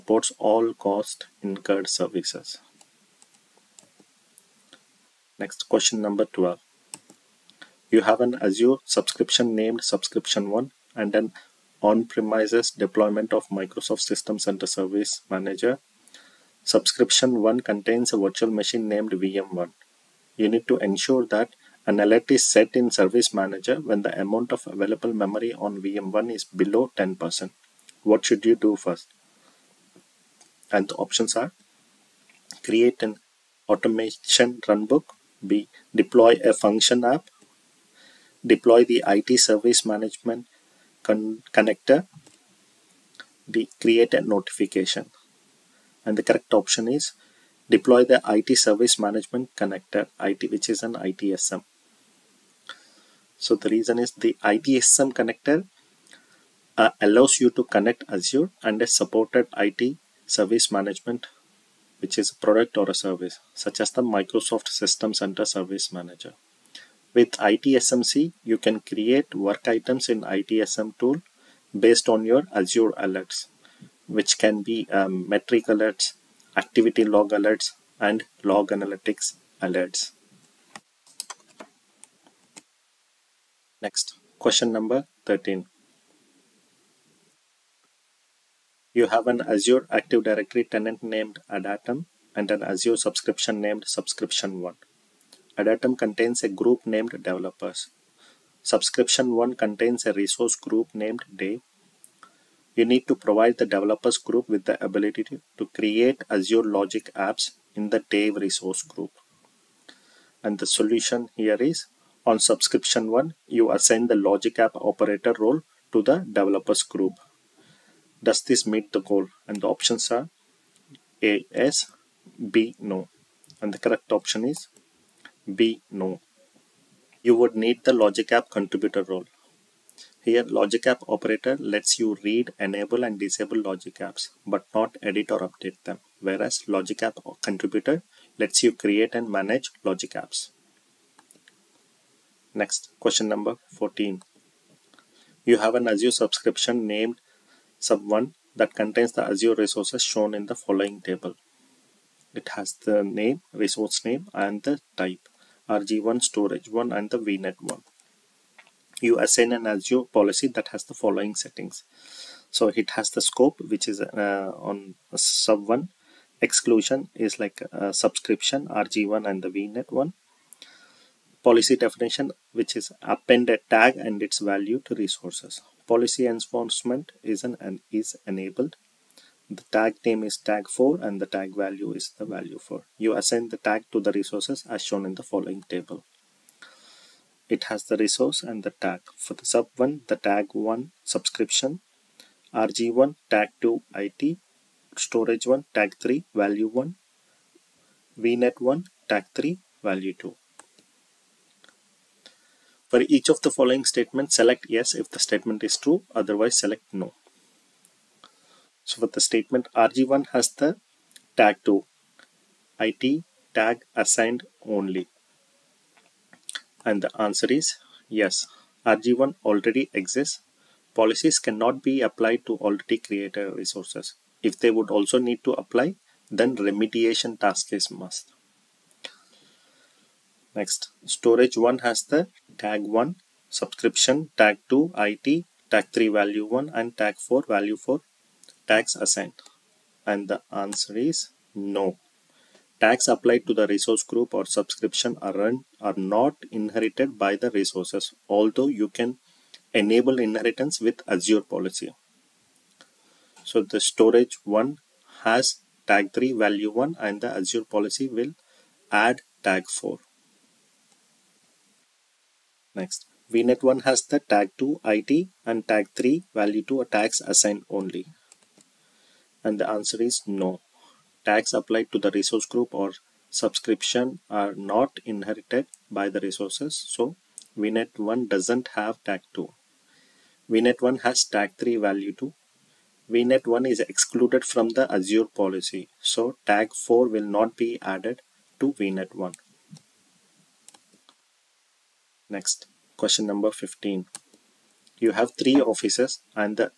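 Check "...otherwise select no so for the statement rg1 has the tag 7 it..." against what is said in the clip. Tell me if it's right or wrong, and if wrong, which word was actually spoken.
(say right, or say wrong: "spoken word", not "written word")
wrong: "2", not "7".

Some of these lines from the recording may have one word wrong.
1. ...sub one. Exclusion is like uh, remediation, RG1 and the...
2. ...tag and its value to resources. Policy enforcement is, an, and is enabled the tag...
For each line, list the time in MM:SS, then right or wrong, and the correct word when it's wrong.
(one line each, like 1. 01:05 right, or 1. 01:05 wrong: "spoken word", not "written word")
1. 02:45 wrong: "subscription", not "remediation"
2. 02:53 right.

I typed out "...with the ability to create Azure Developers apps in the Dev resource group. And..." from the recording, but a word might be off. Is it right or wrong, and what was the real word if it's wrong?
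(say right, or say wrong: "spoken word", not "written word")
wrong: "Logic", not "Developers".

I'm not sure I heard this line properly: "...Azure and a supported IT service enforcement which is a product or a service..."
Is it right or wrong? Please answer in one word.
wrong.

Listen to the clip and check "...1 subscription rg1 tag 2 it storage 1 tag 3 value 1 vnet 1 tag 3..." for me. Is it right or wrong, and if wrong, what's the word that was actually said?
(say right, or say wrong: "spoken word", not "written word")
right.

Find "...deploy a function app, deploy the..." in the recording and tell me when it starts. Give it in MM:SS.
00:35.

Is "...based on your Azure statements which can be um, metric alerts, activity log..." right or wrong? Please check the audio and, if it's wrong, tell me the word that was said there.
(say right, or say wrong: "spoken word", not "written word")
wrong: "alerts", not "statements".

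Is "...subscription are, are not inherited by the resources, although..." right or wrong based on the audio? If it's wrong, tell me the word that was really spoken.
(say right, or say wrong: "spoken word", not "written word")
right.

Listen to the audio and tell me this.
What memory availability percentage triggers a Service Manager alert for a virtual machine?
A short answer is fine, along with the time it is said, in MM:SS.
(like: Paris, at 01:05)
10%, at 00:26.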